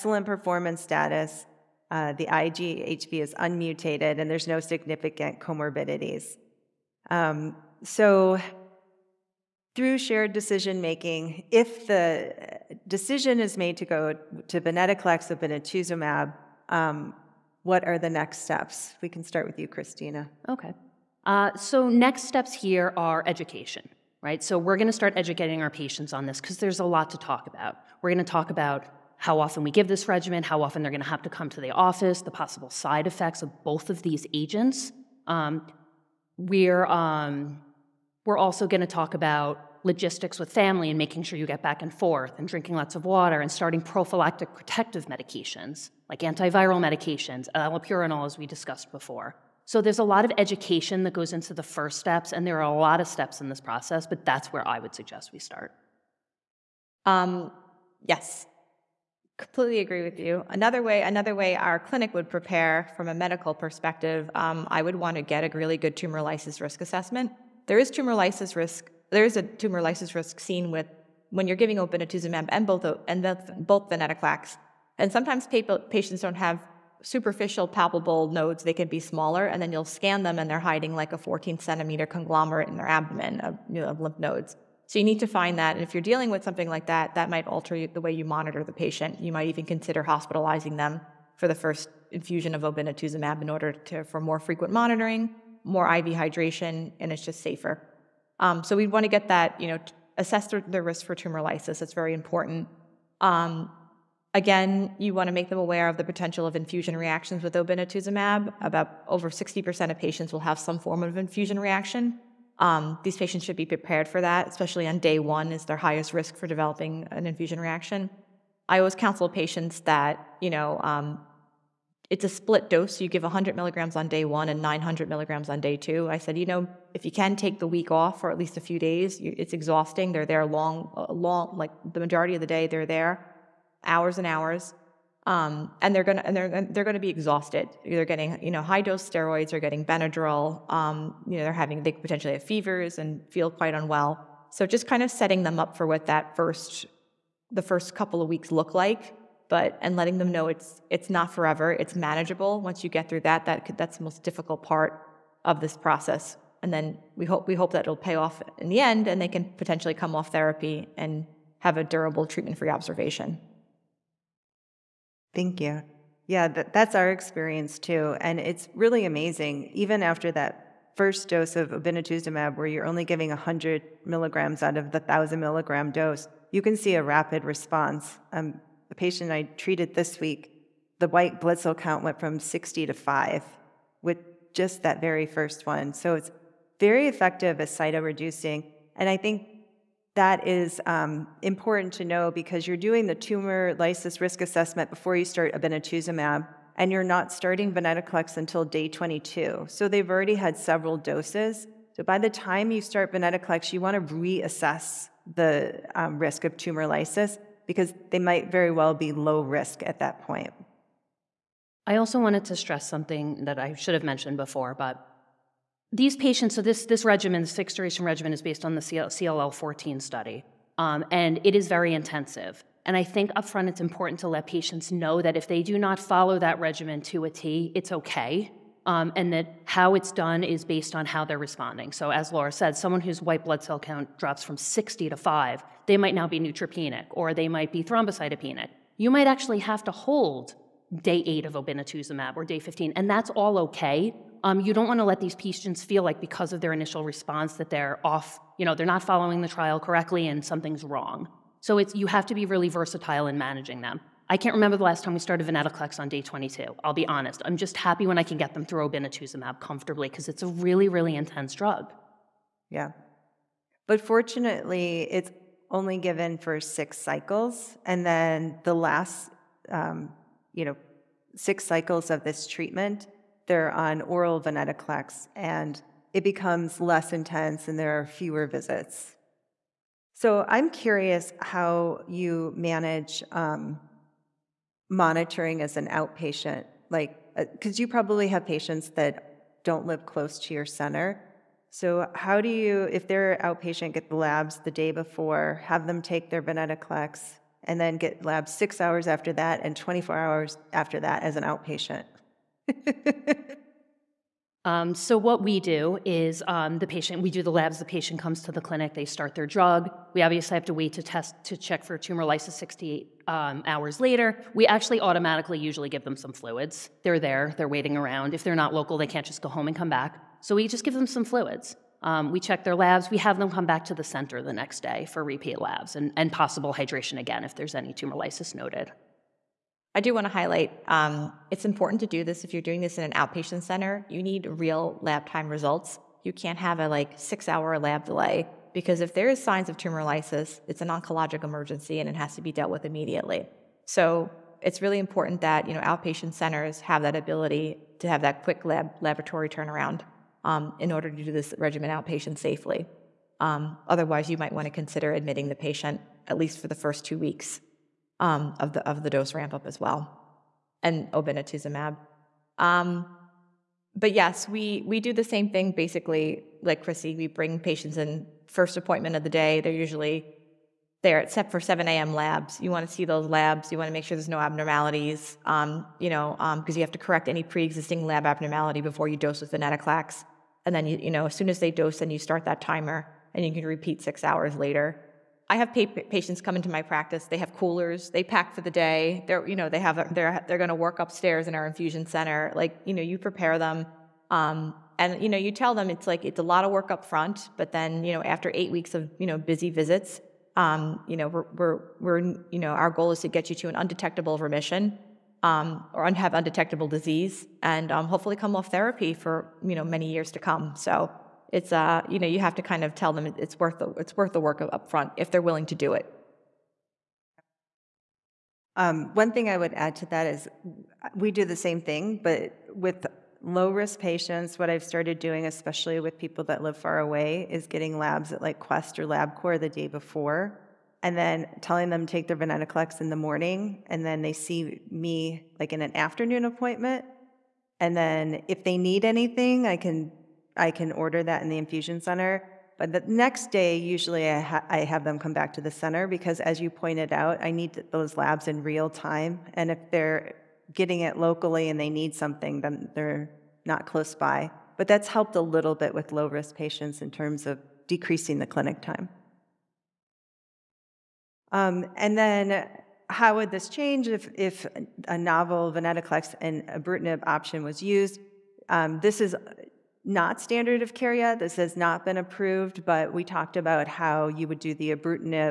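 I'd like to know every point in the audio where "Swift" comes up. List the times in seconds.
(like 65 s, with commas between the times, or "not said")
not said.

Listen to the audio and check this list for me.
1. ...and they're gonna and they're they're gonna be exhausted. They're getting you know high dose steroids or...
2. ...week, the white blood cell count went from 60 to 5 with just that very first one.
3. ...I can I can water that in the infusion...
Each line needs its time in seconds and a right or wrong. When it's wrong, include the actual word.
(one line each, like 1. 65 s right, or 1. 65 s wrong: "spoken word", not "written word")
1. 135 s right
2. 180 s right
3. 439 s wrong: "order", not "water".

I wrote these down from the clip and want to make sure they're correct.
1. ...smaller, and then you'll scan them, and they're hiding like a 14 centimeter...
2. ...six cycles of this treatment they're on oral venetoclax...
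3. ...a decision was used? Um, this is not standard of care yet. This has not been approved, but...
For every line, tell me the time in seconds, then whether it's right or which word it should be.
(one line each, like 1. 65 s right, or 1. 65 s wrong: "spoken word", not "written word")
1. 79 s right
2. 271 s right
3. 466 s wrong: "option", not "decision".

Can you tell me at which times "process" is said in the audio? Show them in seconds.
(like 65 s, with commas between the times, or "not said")
53 s, 155 s.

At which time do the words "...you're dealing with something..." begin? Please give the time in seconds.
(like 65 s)
85 s.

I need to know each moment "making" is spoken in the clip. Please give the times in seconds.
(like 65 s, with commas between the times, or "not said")
10 s, 40 s.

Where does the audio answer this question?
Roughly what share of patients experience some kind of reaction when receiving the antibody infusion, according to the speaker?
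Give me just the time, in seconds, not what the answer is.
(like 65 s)
109 s.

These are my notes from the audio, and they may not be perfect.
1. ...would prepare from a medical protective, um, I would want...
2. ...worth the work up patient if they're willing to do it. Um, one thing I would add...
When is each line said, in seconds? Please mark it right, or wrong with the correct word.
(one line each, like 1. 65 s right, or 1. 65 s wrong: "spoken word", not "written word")
1. 62 s wrong: "perspective", not "protective"
2. 414 s wrong: "front", not "patient".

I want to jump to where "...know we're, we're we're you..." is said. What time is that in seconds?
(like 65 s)
401 s.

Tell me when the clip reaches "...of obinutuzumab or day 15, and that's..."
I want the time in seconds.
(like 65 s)
241 s.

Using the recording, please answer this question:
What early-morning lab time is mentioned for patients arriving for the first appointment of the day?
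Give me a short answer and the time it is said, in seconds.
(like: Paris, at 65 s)
7 a.m., at 371 s.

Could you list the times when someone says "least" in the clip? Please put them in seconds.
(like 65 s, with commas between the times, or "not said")
128 s, 356 s.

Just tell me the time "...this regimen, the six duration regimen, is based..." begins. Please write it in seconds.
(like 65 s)
216 s.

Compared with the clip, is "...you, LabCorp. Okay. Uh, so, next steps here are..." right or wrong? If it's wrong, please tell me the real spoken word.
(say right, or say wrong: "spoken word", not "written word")
wrong: "Christina", not "LabCorp".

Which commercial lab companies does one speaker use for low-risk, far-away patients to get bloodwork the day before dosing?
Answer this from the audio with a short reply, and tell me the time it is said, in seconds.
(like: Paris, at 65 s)
Quest or LabCorp, at 428 s.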